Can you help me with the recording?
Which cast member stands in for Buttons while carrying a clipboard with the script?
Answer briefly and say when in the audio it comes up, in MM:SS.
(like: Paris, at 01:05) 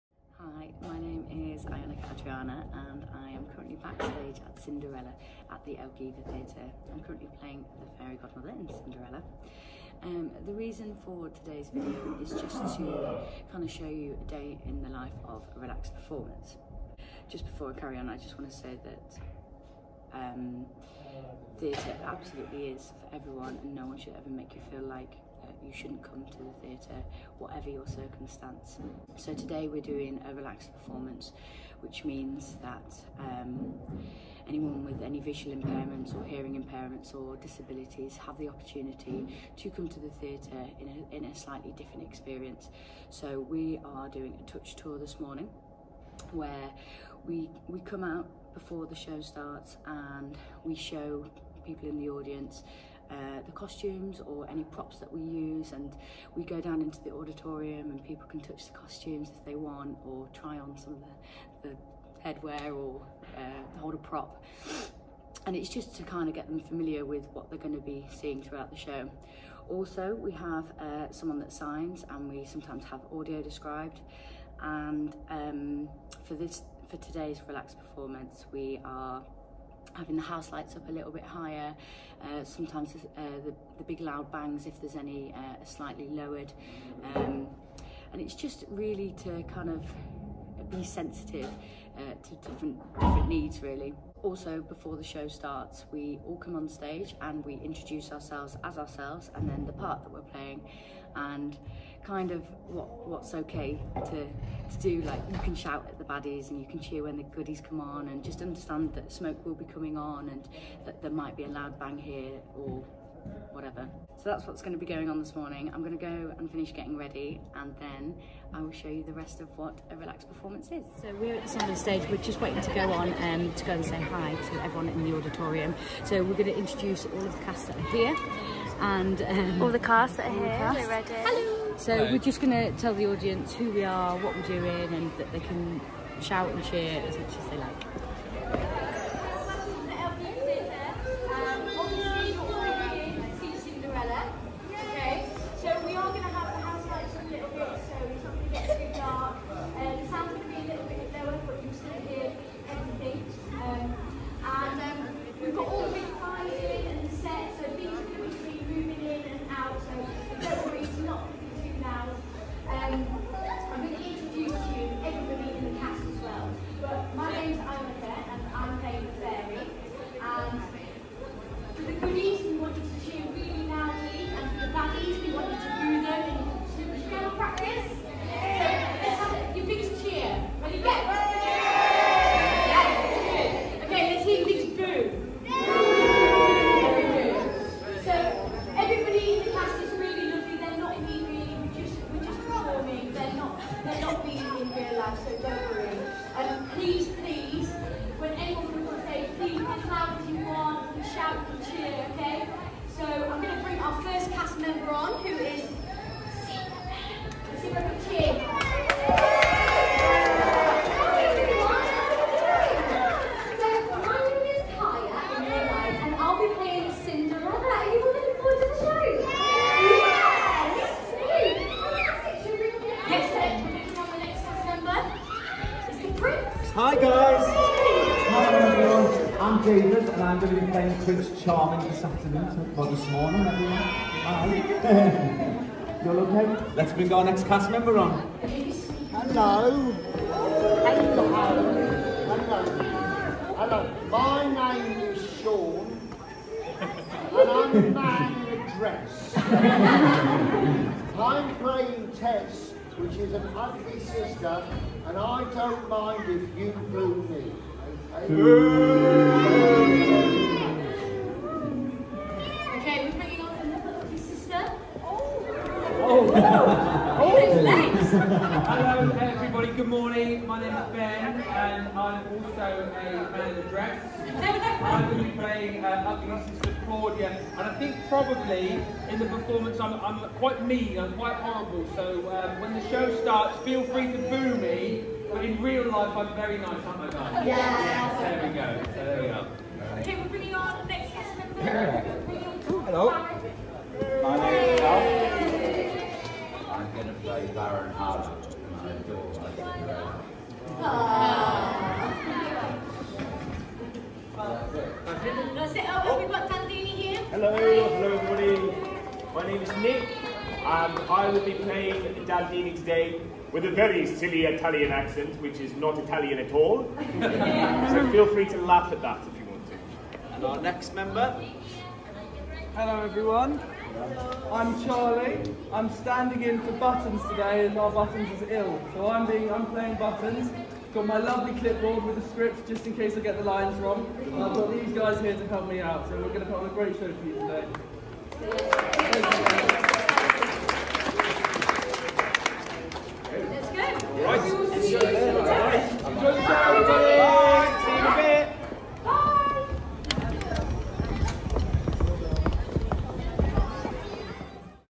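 Charlie, at 05:24.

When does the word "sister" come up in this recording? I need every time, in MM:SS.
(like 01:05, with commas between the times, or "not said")
04:13, 04:24.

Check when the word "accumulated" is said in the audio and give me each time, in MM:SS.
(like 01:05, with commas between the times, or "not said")
not said.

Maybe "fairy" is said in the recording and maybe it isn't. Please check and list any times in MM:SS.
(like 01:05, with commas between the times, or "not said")
00:08.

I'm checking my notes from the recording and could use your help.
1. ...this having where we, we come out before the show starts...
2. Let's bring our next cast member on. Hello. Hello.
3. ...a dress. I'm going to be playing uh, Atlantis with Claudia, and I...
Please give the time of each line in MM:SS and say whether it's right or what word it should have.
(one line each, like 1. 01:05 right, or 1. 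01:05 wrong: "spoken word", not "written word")
1. 00:44 wrong: "morning", not "having"
2. 03:56 right
3. 04:33 right.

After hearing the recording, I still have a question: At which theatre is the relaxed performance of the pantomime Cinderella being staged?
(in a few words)
Elgiva Theatre.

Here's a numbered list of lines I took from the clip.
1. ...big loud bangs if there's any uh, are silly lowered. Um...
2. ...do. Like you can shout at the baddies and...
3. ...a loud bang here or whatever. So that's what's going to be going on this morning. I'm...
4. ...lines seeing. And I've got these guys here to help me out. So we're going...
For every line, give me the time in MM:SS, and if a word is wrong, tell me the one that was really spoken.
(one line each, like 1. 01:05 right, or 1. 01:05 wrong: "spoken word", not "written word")
1. 01:23 wrong: "slightly", not "silly"
2. 01:44 right
3. 01:51 right
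4. 05:33 wrong: "wrong", not "seeing".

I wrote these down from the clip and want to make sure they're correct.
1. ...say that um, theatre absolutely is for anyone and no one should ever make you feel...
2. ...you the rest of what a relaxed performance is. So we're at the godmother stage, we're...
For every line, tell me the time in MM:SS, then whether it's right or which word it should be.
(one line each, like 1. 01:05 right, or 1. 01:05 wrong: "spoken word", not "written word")
1. 00:18 wrong: "everyone", not "anyone"
2. 01:58 wrong: "summer", not "godmother".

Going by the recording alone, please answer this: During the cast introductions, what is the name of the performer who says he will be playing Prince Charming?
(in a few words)
David.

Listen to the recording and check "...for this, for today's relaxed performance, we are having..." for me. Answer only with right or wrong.
right.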